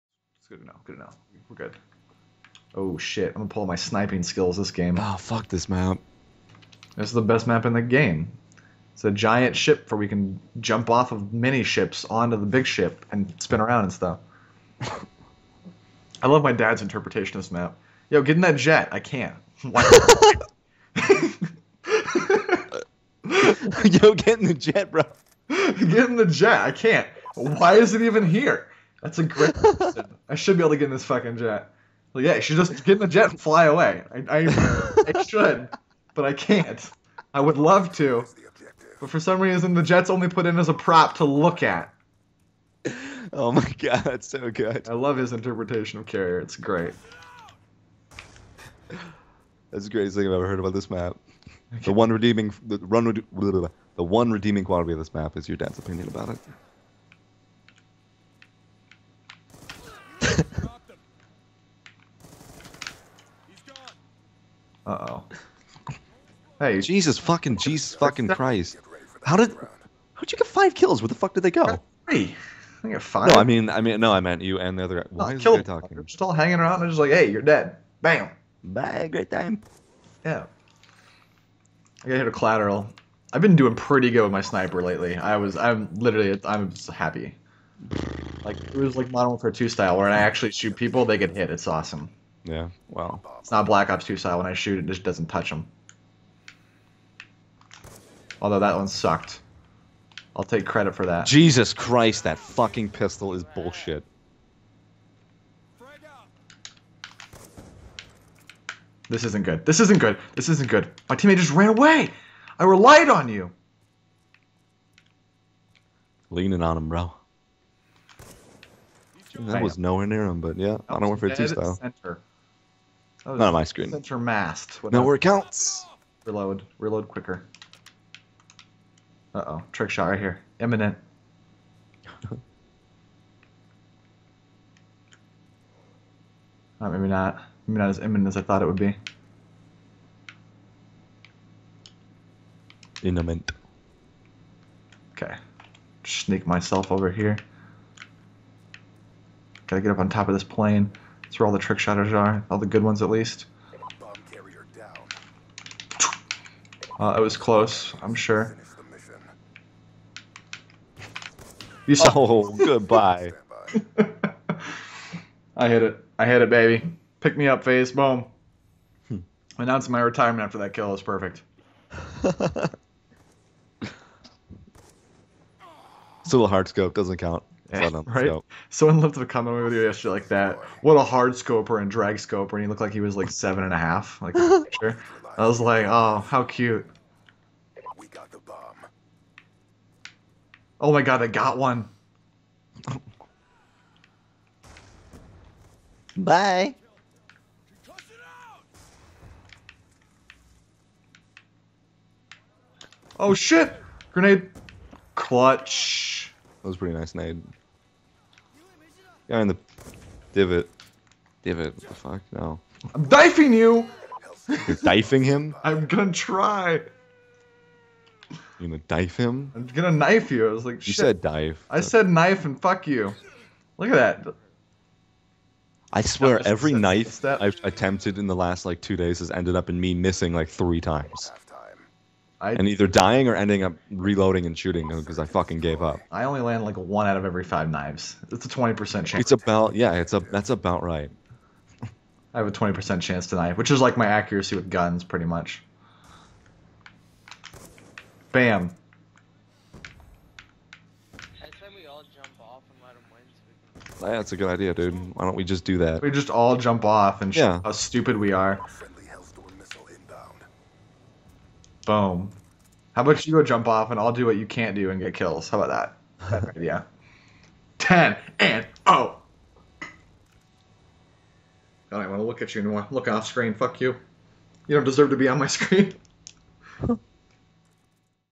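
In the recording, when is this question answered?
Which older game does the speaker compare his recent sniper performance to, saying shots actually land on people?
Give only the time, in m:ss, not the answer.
1:29.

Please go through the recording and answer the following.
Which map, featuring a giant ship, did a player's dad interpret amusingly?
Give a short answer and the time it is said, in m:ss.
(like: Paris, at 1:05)
Carrier, at 0:46.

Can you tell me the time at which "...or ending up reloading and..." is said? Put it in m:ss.
3:53.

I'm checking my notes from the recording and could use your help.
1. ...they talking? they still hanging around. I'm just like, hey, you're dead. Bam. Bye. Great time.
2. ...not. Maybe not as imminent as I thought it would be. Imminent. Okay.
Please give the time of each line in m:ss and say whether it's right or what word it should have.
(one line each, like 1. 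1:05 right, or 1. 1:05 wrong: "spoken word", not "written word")
1. 1:15 right
2. 2:17 right.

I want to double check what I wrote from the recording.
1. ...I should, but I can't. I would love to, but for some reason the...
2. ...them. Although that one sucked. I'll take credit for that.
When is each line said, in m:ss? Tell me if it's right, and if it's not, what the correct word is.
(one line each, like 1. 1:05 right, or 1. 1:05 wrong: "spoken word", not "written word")
1. 0:35 right
2. 1:35 right.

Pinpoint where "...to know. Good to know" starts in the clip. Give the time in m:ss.
0:00.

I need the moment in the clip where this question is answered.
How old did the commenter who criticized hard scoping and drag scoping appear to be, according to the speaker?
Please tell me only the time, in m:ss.
3:03.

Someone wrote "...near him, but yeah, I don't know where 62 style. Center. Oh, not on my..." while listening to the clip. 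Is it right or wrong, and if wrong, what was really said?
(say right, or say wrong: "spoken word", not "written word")
wrong: "52", not "62".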